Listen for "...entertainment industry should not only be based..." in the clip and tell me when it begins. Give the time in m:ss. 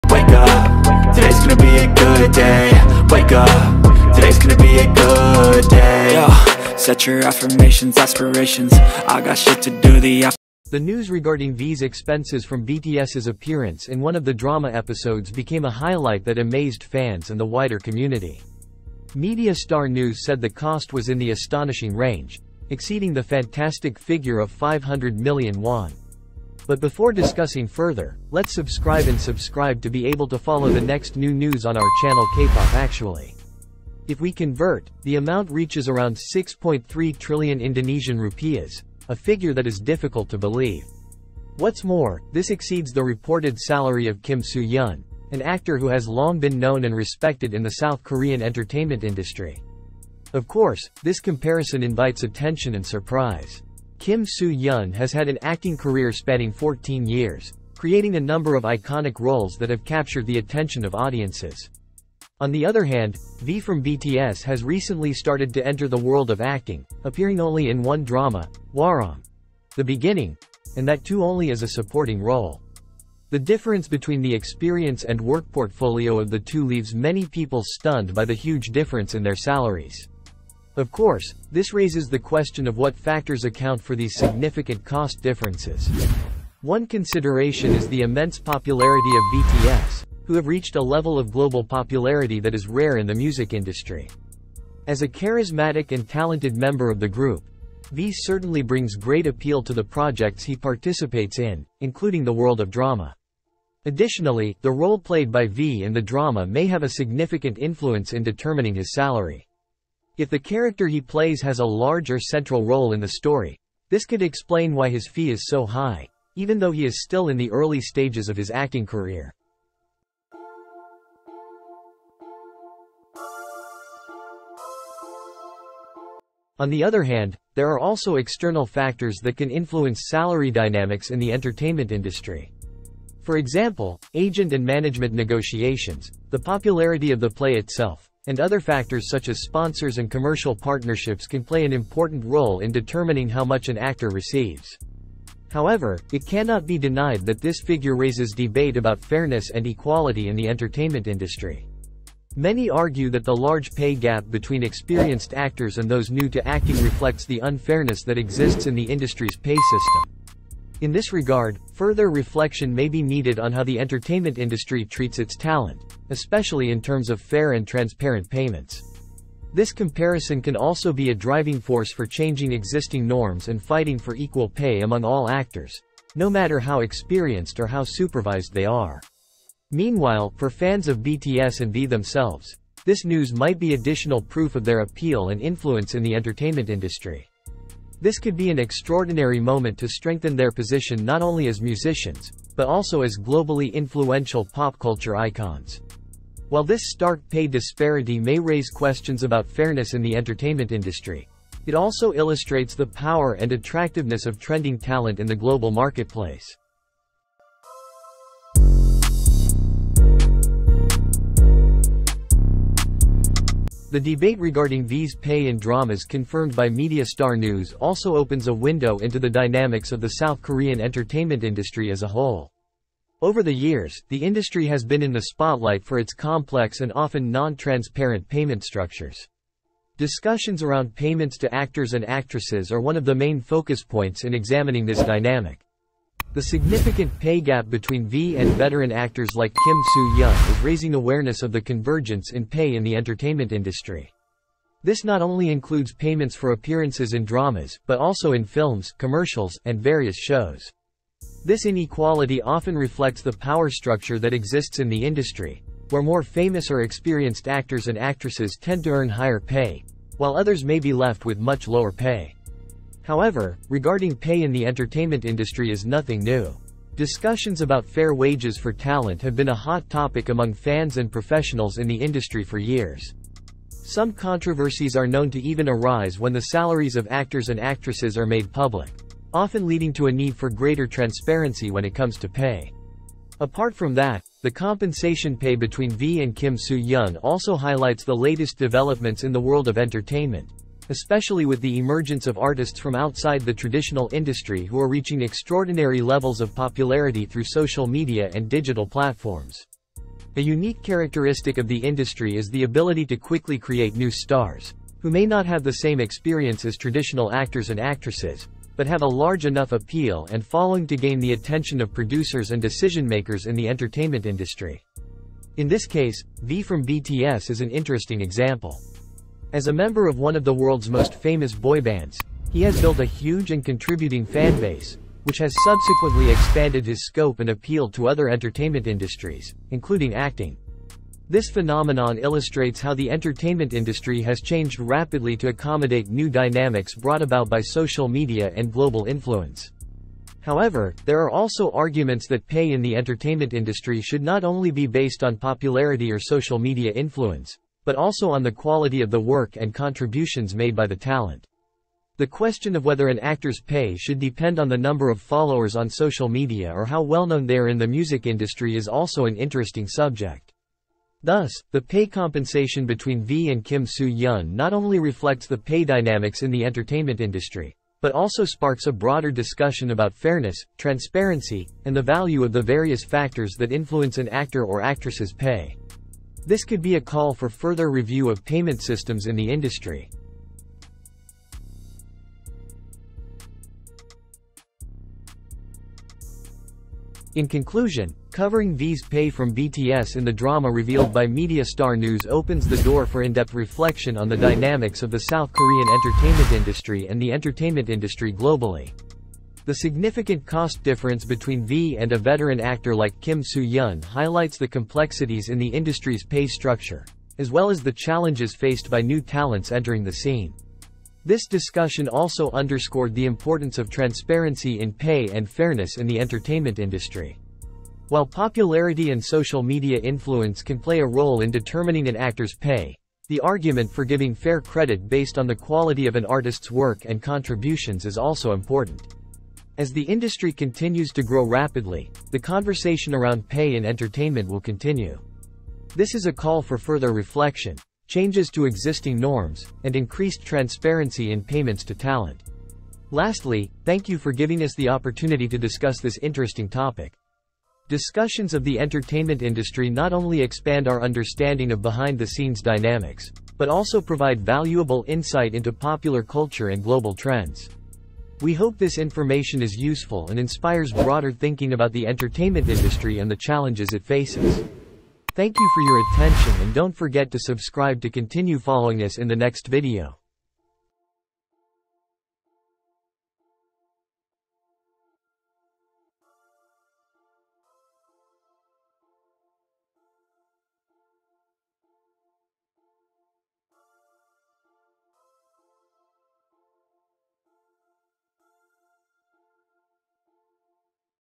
5:42.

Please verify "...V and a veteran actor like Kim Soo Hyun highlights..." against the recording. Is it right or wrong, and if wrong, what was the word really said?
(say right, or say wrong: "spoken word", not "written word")
right.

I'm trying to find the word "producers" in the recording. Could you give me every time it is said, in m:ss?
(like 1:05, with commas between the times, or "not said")
5:11.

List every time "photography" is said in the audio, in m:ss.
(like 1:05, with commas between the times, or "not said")
not said.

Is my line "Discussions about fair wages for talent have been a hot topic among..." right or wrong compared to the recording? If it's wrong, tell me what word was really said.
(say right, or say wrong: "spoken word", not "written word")
right.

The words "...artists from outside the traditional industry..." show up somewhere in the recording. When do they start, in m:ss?
4:52.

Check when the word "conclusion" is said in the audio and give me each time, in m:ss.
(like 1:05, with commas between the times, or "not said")
6:27.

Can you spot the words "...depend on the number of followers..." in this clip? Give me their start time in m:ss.
5:54.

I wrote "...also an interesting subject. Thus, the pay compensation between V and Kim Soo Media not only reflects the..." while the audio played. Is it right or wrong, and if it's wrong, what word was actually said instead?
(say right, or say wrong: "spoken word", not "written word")
wrong: "Hyun", not "Media".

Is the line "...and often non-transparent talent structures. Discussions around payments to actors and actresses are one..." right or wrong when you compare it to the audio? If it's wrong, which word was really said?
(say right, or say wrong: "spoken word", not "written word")
wrong: "payment", not "talent".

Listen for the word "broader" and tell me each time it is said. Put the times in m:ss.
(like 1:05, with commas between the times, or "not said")
6:08, 7:40.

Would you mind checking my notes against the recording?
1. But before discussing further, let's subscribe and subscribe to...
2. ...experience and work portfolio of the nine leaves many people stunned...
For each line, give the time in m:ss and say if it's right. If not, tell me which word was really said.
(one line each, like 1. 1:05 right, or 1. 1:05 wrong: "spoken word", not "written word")
1. 0:26 right
2. 1:14 wrong: "two", not "nine".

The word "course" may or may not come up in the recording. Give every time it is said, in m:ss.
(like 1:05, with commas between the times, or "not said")
0:50, 1:20.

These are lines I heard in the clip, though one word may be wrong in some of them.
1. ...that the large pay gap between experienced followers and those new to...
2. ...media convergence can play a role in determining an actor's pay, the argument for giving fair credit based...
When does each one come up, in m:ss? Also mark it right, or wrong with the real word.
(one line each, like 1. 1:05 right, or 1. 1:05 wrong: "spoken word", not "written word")
1. 2:33 wrong: "actors", not "followers"
2. 6:59 wrong: "influence", not "convergence".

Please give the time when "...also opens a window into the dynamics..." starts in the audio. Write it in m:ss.
3:37.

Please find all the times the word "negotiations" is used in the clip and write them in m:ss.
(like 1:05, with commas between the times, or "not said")
2:15.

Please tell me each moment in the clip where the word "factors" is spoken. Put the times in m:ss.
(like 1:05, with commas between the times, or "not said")
1:22, 2:08, 2:18, 6:13.